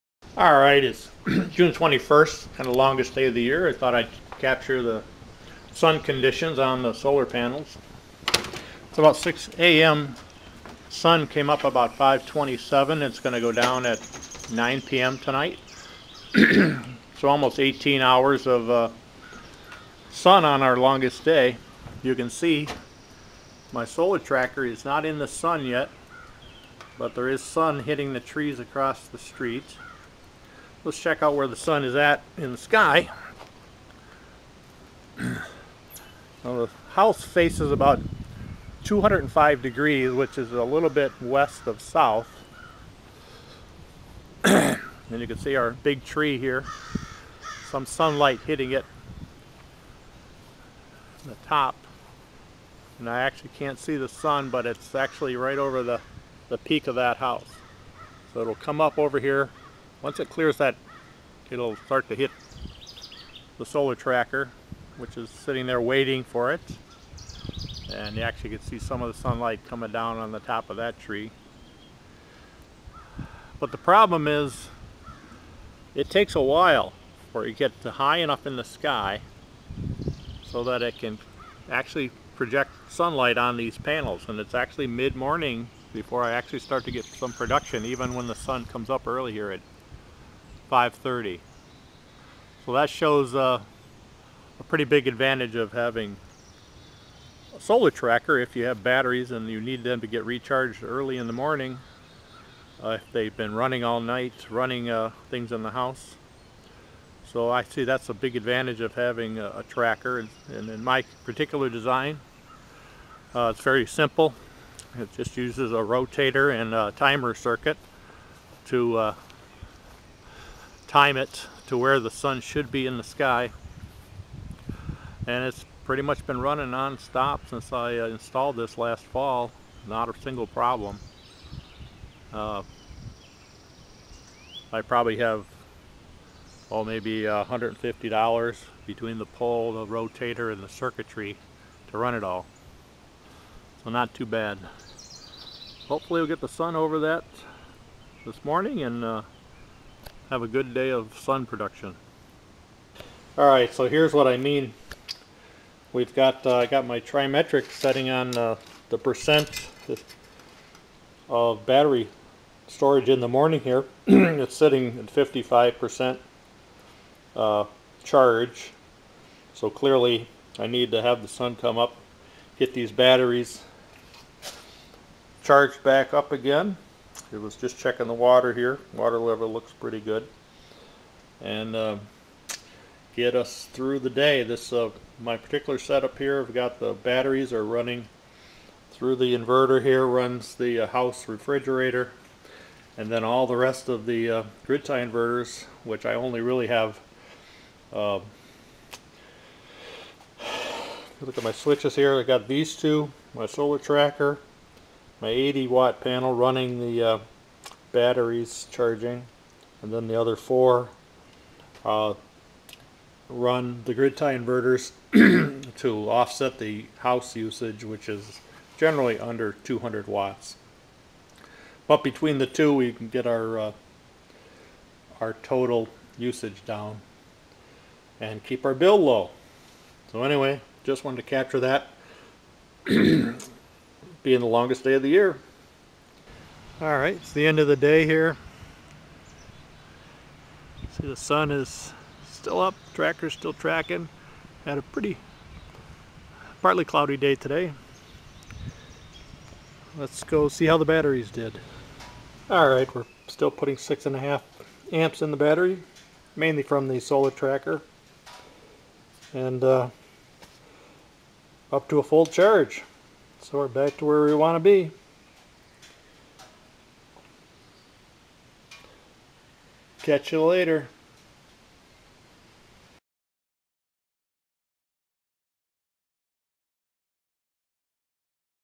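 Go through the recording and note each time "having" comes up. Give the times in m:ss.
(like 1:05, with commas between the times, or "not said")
1:35, 1:48.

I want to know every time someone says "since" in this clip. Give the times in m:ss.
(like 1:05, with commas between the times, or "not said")
2:07.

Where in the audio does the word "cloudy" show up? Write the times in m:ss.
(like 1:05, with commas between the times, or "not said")
4:06.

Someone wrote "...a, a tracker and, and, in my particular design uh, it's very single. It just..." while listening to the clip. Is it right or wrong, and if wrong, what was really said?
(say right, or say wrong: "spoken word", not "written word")
wrong: "simple", not "single".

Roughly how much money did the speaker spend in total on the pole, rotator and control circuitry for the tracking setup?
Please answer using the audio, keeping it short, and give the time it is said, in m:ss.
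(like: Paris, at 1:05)
$150, at 2:17.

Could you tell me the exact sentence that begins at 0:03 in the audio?
I thought I'd capture the sun conditions on the solar panels.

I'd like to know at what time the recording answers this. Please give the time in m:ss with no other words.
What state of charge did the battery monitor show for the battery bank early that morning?
2:45.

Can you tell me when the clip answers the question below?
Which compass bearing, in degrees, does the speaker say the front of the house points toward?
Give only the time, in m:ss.
0:38.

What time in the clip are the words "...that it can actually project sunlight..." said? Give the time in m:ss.
1:20.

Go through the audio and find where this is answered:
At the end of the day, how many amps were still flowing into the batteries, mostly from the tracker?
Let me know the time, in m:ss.
4:13.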